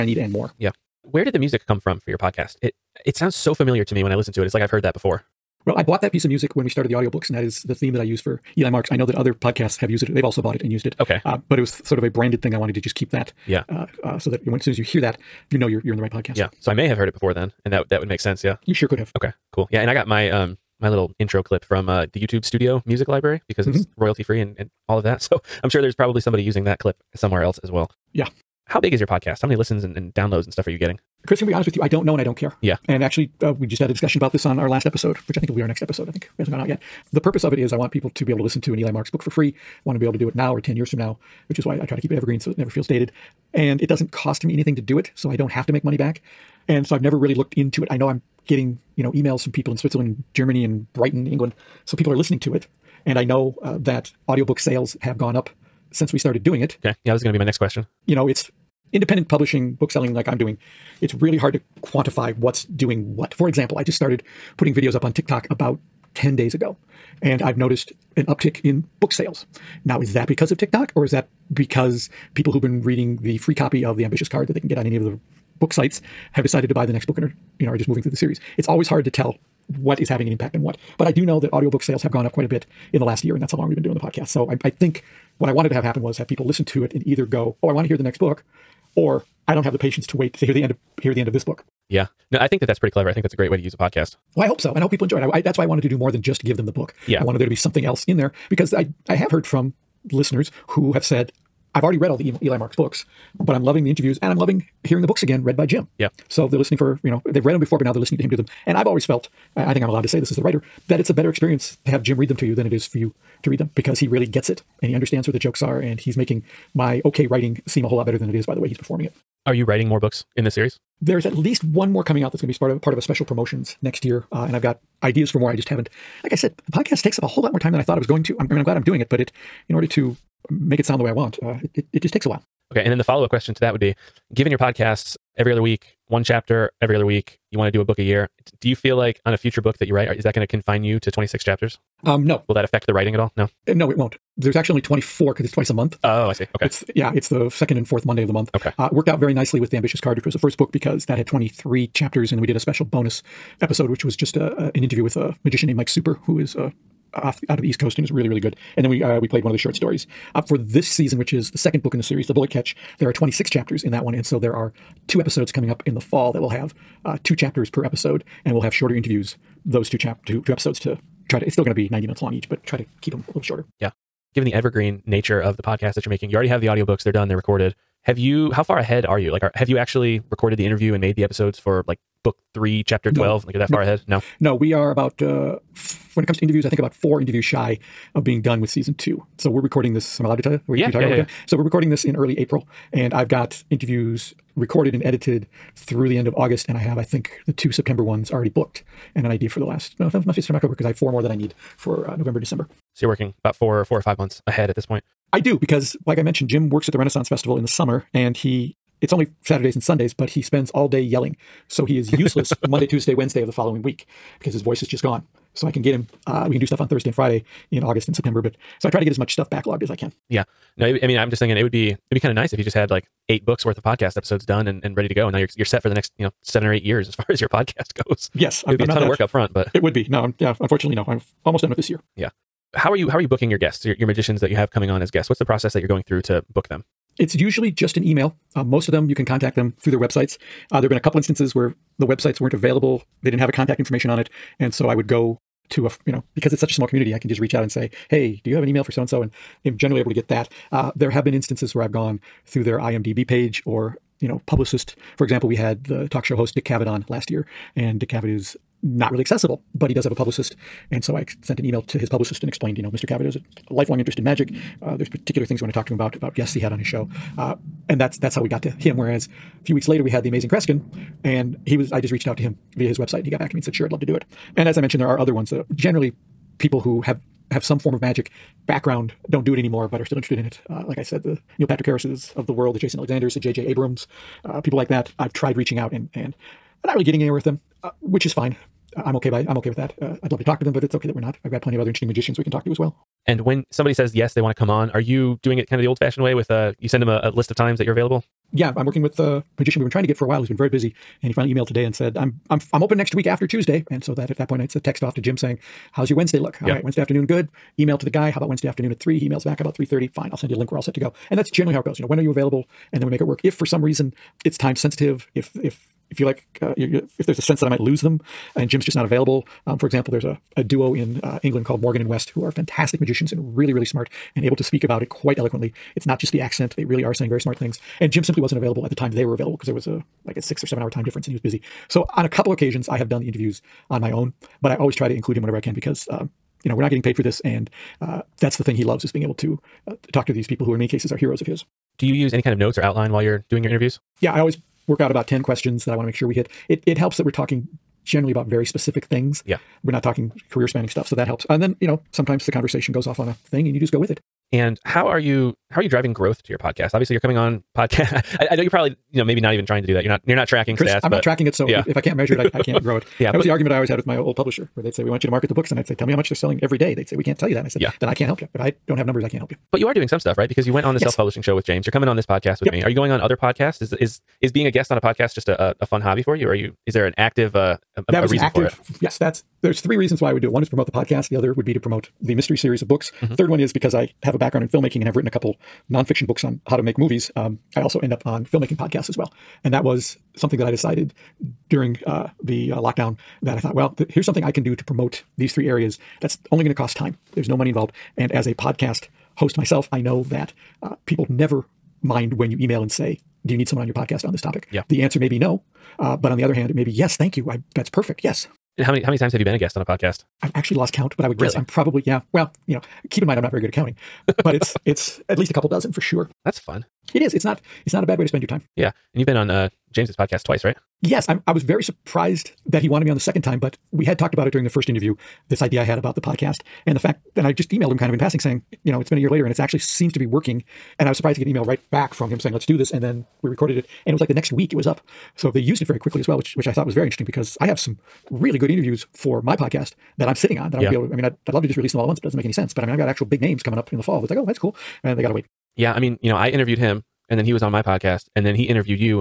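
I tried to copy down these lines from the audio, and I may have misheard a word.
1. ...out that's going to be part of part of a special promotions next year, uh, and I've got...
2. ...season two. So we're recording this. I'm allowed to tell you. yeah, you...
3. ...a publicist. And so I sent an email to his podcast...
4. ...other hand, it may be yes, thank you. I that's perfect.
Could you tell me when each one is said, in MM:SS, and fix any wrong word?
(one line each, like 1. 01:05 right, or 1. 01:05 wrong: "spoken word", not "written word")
1. 02:02 right
2. 03:08 right
3. 04:20 wrong: "publicist", not "podcast"
4. 06:46 right.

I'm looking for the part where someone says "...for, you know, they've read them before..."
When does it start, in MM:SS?
01:46.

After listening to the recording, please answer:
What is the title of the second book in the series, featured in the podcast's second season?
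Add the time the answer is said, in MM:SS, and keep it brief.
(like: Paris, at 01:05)
The Bullet Catch, at 02:42.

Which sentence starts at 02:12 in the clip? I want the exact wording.
Okay, and then the follow up question to that would be, given your podcasts every other week, one chapter every other week.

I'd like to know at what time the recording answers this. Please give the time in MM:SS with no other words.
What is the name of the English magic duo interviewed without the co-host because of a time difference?
05:21.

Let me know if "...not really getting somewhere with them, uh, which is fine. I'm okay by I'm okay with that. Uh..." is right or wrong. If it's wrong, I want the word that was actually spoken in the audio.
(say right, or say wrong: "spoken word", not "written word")
wrong: "anywhere", not "somewhere".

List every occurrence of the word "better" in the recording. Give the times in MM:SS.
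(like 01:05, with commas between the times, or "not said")
01:51, 01:58.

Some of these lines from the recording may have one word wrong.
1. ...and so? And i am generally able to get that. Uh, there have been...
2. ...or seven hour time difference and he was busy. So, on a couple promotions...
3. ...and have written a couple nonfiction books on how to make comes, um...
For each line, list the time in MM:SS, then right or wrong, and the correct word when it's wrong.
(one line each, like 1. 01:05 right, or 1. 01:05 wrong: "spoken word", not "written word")
1. 04:09 right
2. 05:30 wrong: "occasions", not "promotions"
3. 06:25 wrong: "movies", not "comes".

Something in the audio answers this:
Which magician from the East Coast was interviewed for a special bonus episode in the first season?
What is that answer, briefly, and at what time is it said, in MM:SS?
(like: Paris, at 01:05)
Mike Super, at 02:35.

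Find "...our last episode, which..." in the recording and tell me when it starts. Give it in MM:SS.
00:34.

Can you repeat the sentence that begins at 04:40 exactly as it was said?
Uh, like I said, the Neil Patrick Harris's of the world, the Jason Alexanders, the J.J.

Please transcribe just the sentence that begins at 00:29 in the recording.
How many listens and, and downloads and stuff are you getting?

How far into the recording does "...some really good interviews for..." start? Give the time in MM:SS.
07:17.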